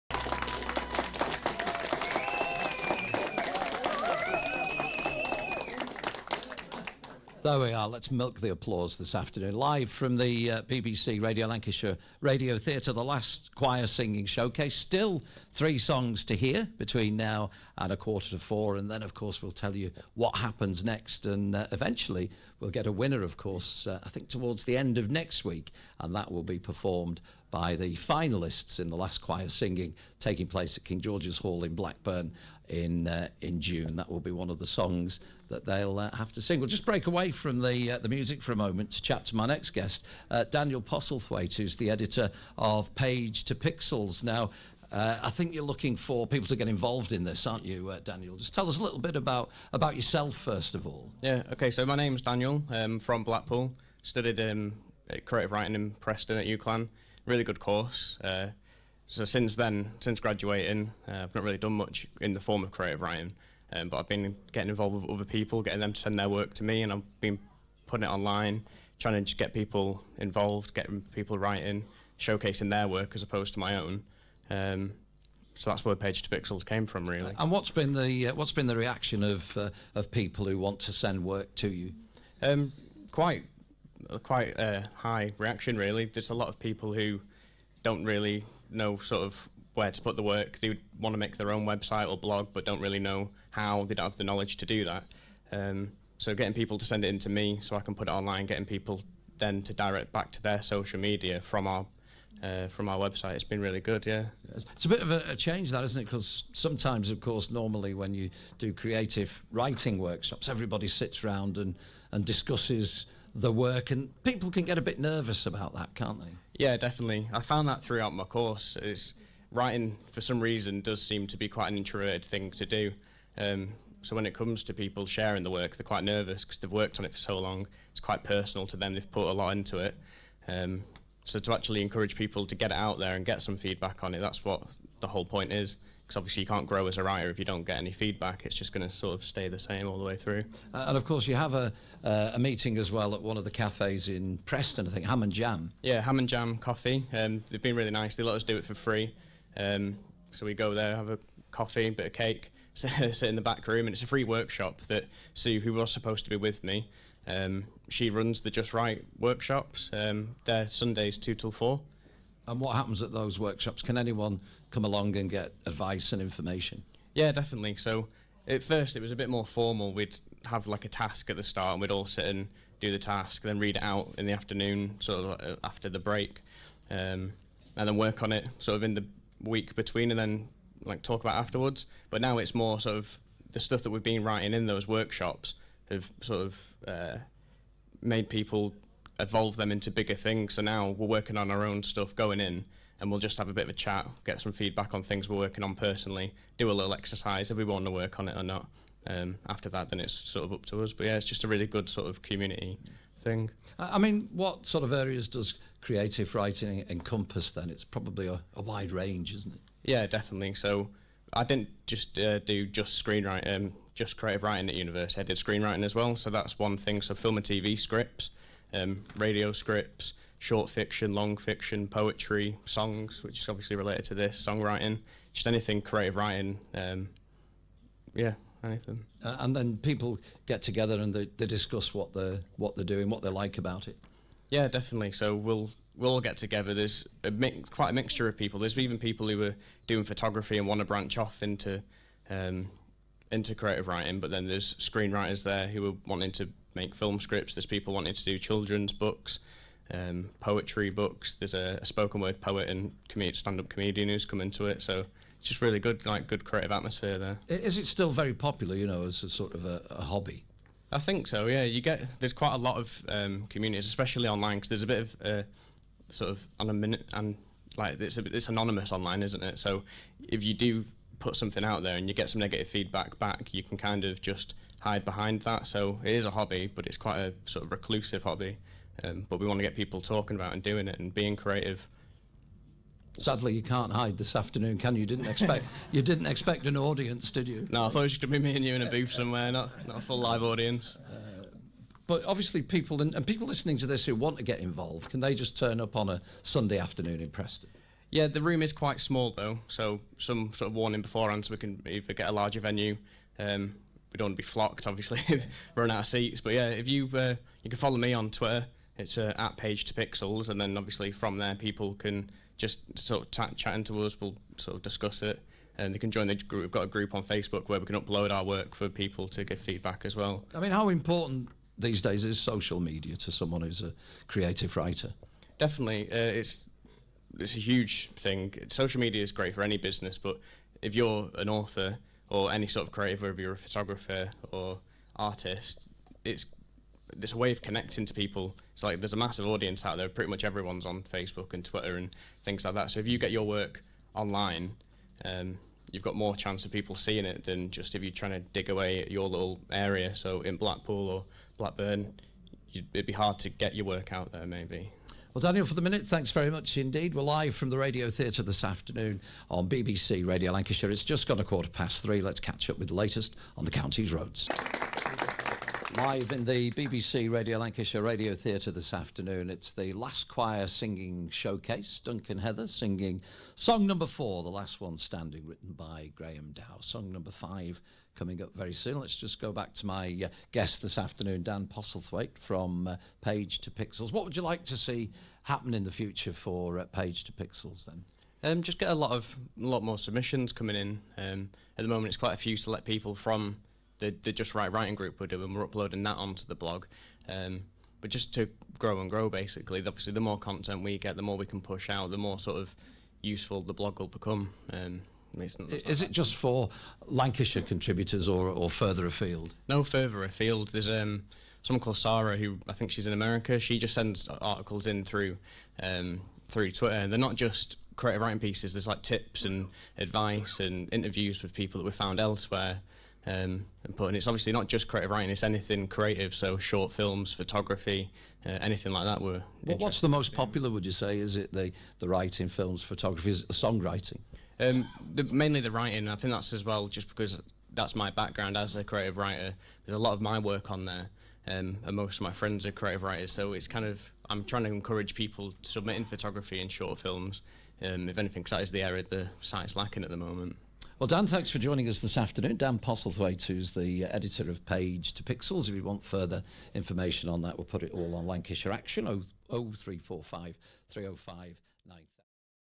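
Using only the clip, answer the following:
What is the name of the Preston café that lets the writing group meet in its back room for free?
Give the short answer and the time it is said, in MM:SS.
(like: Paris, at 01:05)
Ham and Jam Coffee, at 02:26.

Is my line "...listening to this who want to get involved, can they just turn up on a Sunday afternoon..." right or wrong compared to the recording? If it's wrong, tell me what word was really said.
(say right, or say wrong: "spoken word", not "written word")
right.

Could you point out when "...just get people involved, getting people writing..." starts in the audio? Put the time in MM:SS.
01:09.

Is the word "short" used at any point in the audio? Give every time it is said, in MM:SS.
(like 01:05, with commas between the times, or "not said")
03:40, 07:06, 07:26.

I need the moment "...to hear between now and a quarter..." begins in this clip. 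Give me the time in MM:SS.
00:16.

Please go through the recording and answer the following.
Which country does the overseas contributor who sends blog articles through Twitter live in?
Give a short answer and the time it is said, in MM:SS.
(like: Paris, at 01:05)
America, at 06:53.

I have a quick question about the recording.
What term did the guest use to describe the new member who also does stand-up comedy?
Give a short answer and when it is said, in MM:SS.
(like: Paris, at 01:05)
Spoken word poet, at 04:11.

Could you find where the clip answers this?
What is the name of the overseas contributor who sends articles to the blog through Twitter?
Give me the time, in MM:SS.
06:51.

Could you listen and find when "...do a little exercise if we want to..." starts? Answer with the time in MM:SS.
03:16.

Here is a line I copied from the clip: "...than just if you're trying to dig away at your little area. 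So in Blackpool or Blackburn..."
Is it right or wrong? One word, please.
right.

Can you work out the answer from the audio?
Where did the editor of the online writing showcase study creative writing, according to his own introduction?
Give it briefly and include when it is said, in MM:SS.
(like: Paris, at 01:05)
UCLan, at 00:56.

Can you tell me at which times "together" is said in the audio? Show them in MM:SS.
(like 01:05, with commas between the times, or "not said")
03:50, 03:56.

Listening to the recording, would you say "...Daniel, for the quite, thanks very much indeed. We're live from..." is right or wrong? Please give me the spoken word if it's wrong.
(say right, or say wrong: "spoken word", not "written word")
wrong: "minute", not "quite".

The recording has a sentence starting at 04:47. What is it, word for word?
No, I thought it was going to be me and you in a booth somewhere, not not a full live audience.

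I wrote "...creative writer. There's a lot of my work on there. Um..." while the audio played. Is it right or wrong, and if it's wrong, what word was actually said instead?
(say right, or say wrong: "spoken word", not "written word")
right.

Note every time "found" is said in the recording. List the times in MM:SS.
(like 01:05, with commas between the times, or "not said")
01:57, 07:01.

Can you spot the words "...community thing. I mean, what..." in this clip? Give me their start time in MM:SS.
03:22.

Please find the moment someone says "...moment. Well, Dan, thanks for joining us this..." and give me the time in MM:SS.
07:30.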